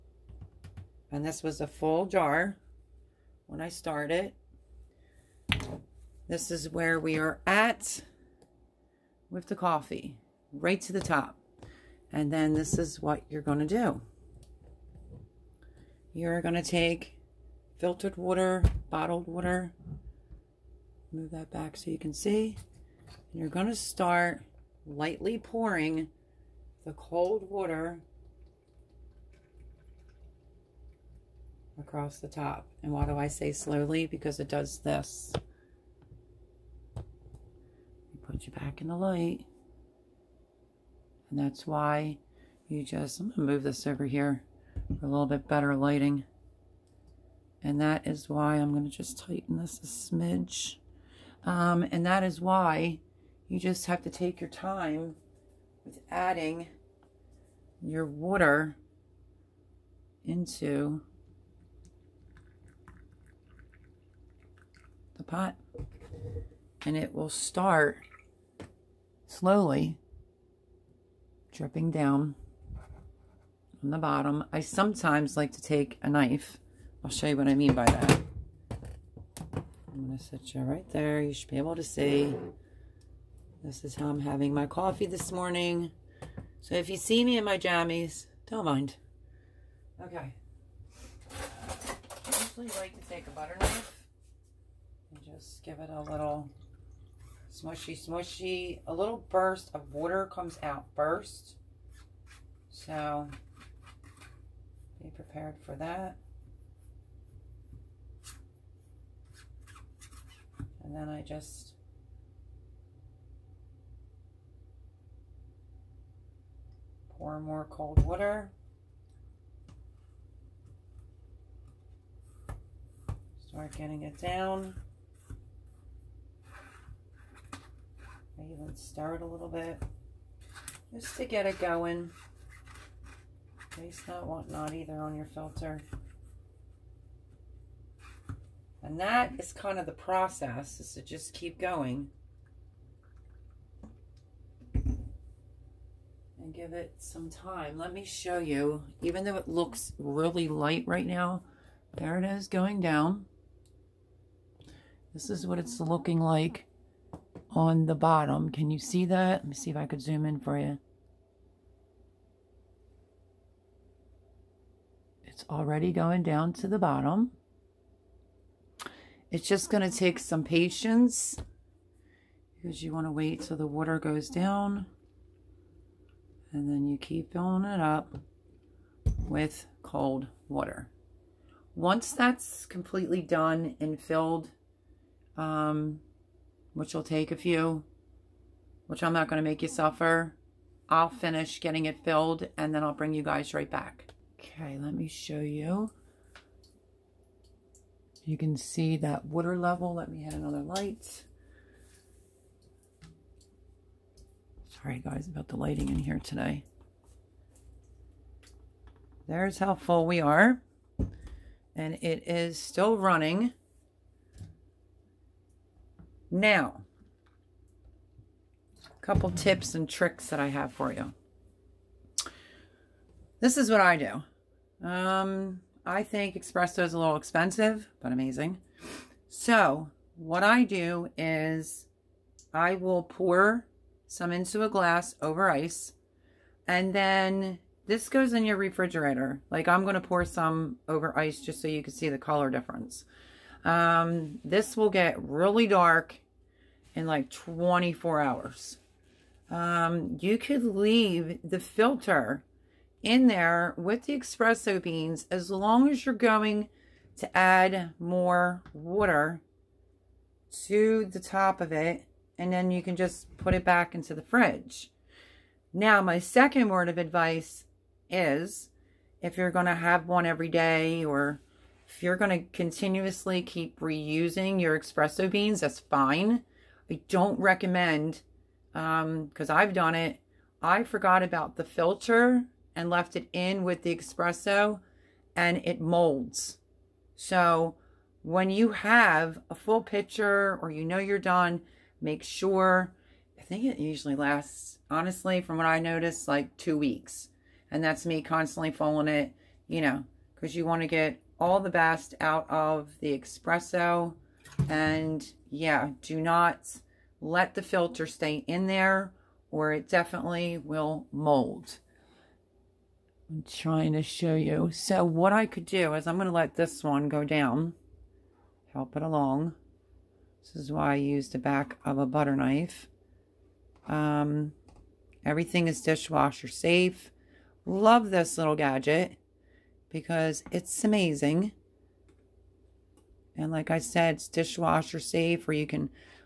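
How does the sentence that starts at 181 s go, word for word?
Once that's completely done and filled, um, which will take a few, which I'm not going to make you suffer.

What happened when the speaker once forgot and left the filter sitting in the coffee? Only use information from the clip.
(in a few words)
it molds.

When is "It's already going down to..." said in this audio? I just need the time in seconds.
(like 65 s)
165 s.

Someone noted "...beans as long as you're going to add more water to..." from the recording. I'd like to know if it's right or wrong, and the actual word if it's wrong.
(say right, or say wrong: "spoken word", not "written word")
right.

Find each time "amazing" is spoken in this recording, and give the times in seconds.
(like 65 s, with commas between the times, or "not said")
228 s, 330 s.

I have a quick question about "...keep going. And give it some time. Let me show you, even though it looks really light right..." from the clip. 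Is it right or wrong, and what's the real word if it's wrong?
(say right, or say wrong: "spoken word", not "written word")
right.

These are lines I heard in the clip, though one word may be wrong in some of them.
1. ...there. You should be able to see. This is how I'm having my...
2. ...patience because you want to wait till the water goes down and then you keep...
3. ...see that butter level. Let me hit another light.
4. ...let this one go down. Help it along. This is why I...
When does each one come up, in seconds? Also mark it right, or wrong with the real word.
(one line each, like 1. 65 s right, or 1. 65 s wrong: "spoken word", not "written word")
1. 80 s right
2. 170 s right
3. 198 s wrong: "water", not "butter"
4. 316 s right.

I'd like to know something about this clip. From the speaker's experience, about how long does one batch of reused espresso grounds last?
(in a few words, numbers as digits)
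two weeks.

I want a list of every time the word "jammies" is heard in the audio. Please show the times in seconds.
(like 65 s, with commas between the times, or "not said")
87 s.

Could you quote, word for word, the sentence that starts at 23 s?
And you're going to start lightly pouring the cold water across the top.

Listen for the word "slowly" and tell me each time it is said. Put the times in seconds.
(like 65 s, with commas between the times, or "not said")
33 s, 69 s.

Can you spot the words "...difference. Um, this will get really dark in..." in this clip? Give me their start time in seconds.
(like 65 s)
242 s.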